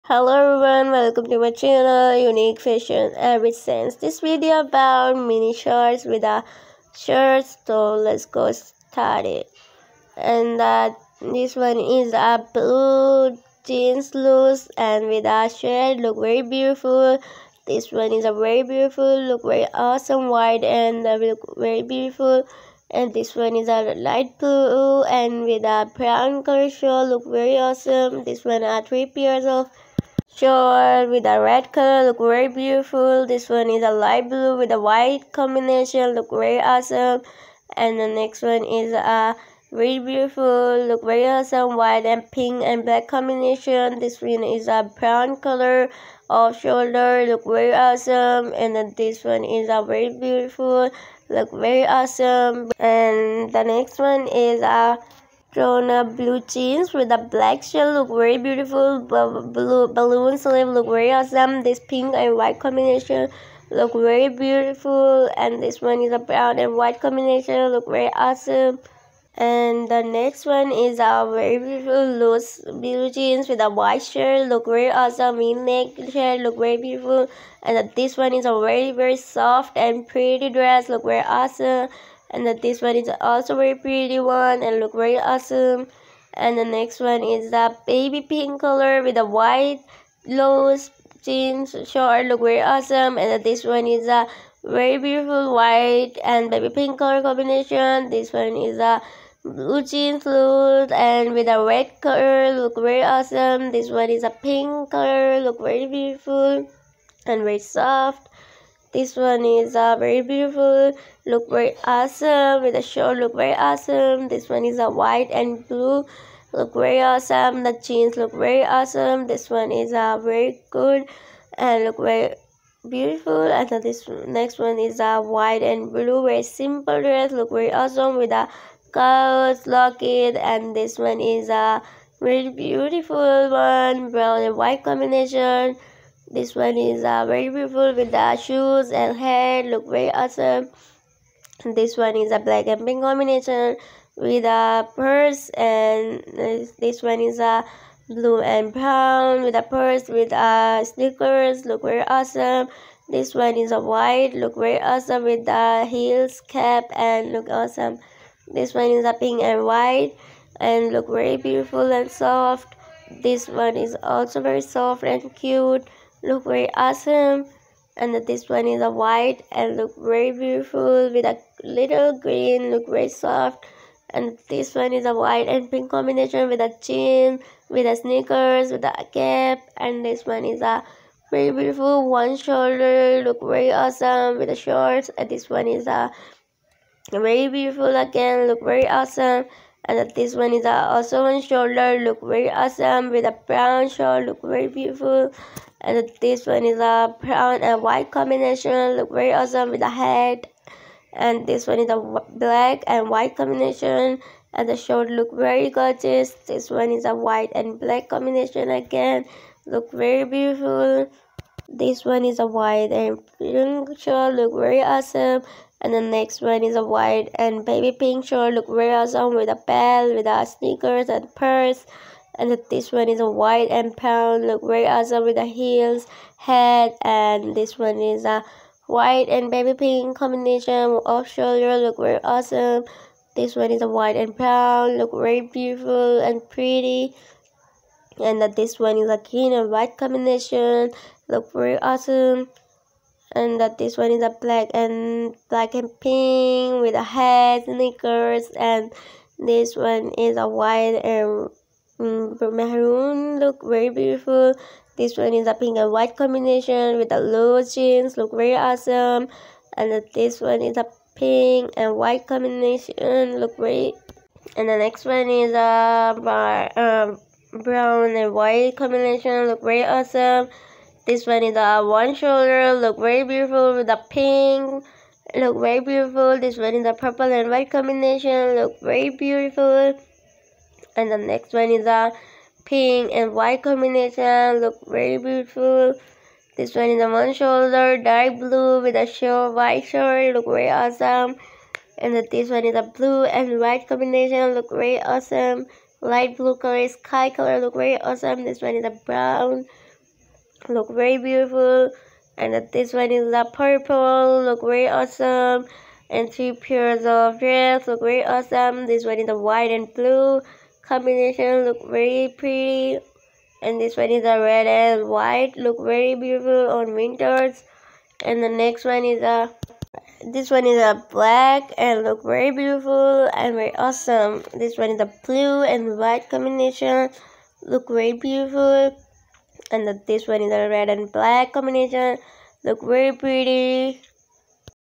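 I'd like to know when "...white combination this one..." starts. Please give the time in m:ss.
2:14.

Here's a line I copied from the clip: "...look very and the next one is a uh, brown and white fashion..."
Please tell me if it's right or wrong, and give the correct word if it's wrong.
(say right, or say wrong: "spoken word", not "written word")
wrong: "combination", not "fashion".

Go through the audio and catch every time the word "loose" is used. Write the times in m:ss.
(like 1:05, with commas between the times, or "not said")
0:14, 1:12, 1:30.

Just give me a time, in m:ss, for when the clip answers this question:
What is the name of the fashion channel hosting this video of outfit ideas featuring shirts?
0:02.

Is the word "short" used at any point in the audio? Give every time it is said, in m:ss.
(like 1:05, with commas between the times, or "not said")
0:30, 1:31, 1:52, 3:04, 4:49.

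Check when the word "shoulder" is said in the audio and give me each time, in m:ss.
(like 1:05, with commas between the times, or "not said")
0:46, 3:02, 3:11, 3:51, 4:32, 4:47.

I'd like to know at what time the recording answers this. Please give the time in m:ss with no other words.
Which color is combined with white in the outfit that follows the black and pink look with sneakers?
4:12.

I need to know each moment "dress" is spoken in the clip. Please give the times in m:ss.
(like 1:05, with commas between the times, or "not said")
1:20, 2:07, 5:07.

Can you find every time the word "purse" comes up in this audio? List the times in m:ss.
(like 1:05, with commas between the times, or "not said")
2:24, 2:29, 3:41.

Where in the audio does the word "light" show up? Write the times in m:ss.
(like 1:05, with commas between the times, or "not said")
0:23, 0:33, 4:56.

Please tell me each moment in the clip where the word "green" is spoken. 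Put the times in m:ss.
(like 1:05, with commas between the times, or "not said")
2:52, 3:59.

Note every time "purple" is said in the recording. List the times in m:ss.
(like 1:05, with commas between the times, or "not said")
4:36, 5:03.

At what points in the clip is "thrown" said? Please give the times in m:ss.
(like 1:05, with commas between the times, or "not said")
0:55.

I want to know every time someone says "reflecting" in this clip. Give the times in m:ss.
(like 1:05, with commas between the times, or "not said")
not said.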